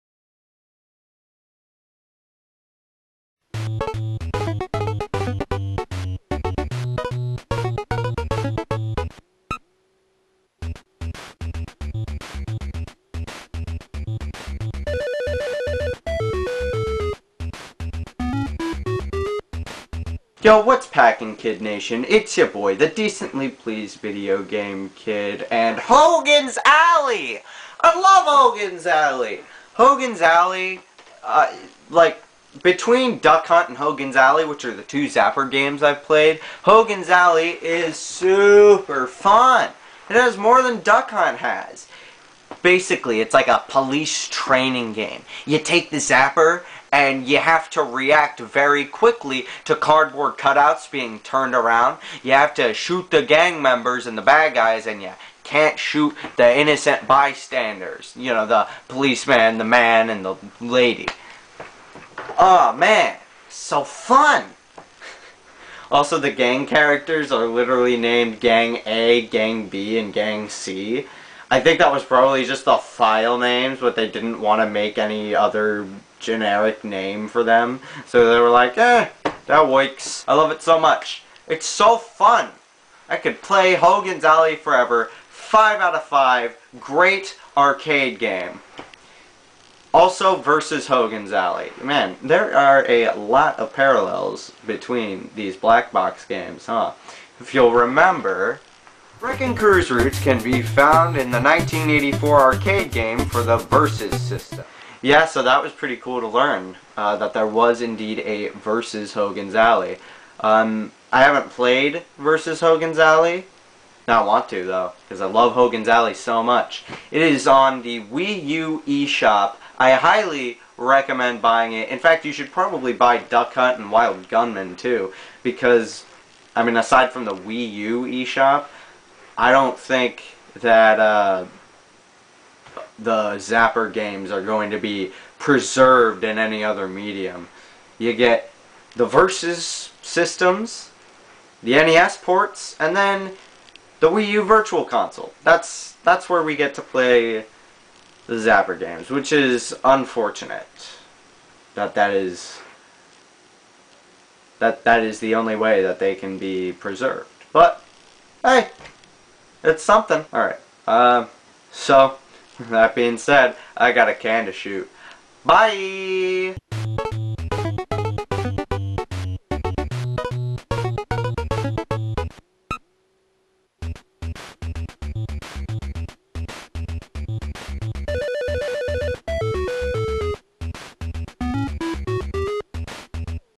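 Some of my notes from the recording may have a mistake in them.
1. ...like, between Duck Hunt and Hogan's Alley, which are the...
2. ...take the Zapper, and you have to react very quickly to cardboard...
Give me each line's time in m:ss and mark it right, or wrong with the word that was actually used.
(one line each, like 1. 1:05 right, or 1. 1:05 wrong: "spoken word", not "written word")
1. 0:31 right
2. 0:45 right.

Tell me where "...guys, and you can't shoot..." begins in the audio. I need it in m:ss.
0:54.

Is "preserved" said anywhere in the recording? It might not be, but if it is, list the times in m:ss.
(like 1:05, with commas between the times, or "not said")
2:15, 2:36.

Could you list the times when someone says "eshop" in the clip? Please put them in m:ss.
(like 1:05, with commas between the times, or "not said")
1:58, 2:08.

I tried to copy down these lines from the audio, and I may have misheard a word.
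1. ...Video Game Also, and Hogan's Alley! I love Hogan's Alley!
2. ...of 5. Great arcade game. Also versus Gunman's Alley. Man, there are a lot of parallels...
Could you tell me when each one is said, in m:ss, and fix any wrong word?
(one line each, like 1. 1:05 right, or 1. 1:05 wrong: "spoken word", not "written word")
1. 0:23 wrong: "Kid", not "Also"
2. 1:25 wrong: "Hogan", not "Gunman".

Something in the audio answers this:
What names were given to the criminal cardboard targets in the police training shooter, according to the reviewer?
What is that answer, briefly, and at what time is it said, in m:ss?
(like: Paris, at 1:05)
Gang A, Gang B, and Gang C, at 1:08.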